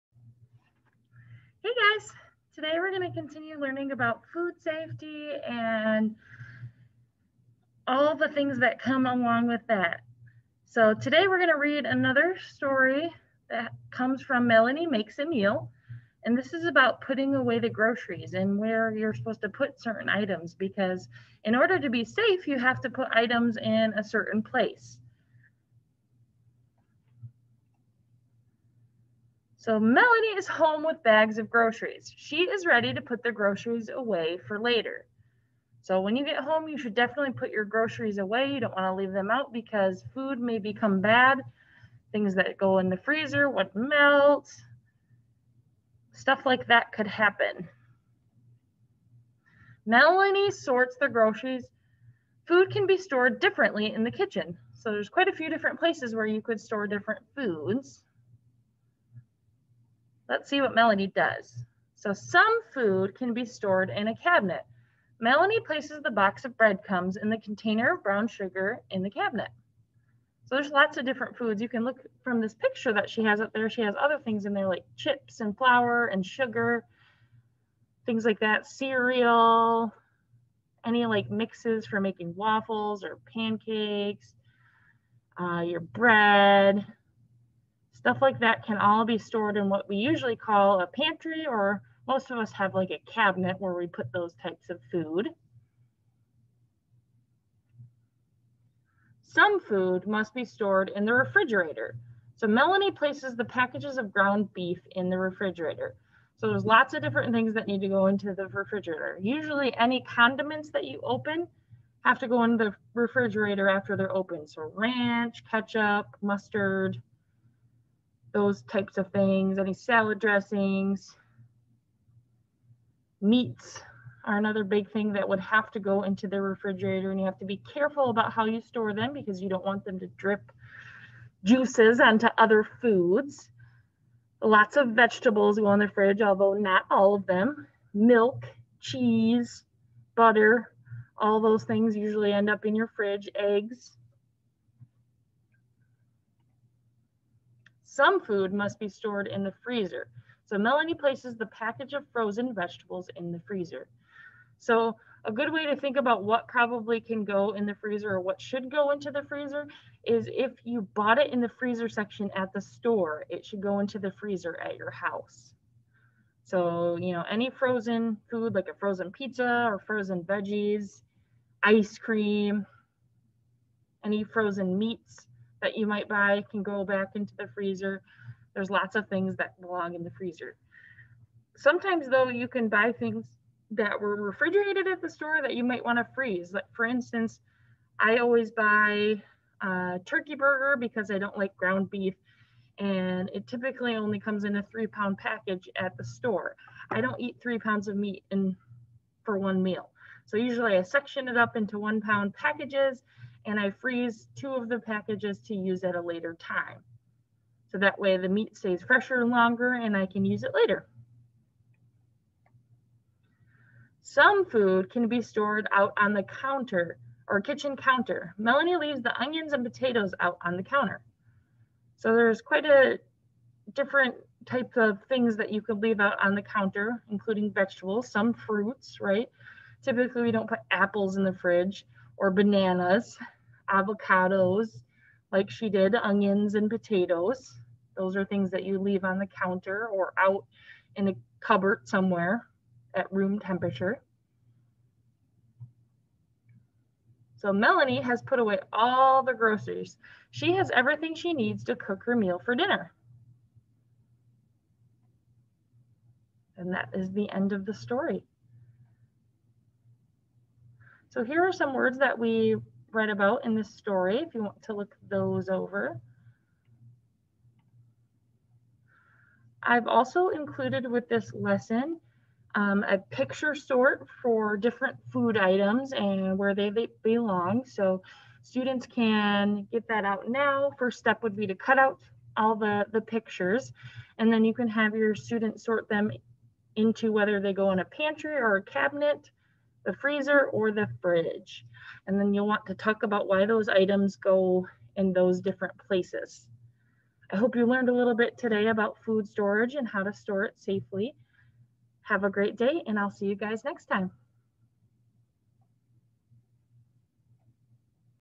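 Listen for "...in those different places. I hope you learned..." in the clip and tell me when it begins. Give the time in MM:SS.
04:54.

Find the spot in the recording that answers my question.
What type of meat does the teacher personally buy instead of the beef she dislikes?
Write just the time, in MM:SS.
03:10.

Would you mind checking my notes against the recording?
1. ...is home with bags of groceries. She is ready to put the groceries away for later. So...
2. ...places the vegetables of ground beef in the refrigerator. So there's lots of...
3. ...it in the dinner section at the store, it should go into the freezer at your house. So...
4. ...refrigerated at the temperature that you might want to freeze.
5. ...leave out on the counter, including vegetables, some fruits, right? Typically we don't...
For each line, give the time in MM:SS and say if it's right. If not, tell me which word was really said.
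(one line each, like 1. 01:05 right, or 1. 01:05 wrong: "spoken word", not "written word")
1. 00:30 right
2. 01:42 wrong: "packages", not "vegetables"
3. 02:41 wrong: "freezer", not "dinner"
4. 03:04 wrong: "store", not "temperature"
5. 03:45 right.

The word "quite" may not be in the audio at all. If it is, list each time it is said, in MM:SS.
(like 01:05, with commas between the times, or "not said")
00:55, 03:42.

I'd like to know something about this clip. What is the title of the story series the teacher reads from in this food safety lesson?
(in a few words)
Melanie Makes a Meal.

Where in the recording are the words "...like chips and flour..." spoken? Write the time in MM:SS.
01:14.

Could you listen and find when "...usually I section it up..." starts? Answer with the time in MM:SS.
03:20.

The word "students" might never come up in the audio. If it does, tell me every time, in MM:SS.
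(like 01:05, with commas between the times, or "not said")
04:38, 04:45.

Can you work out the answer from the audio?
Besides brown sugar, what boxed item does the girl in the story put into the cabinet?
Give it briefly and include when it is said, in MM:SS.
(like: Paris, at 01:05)
breadcrumbs, at 01:06.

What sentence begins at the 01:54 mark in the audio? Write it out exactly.
So ranch, ketchup, mustard, those types of things, any salad dressings.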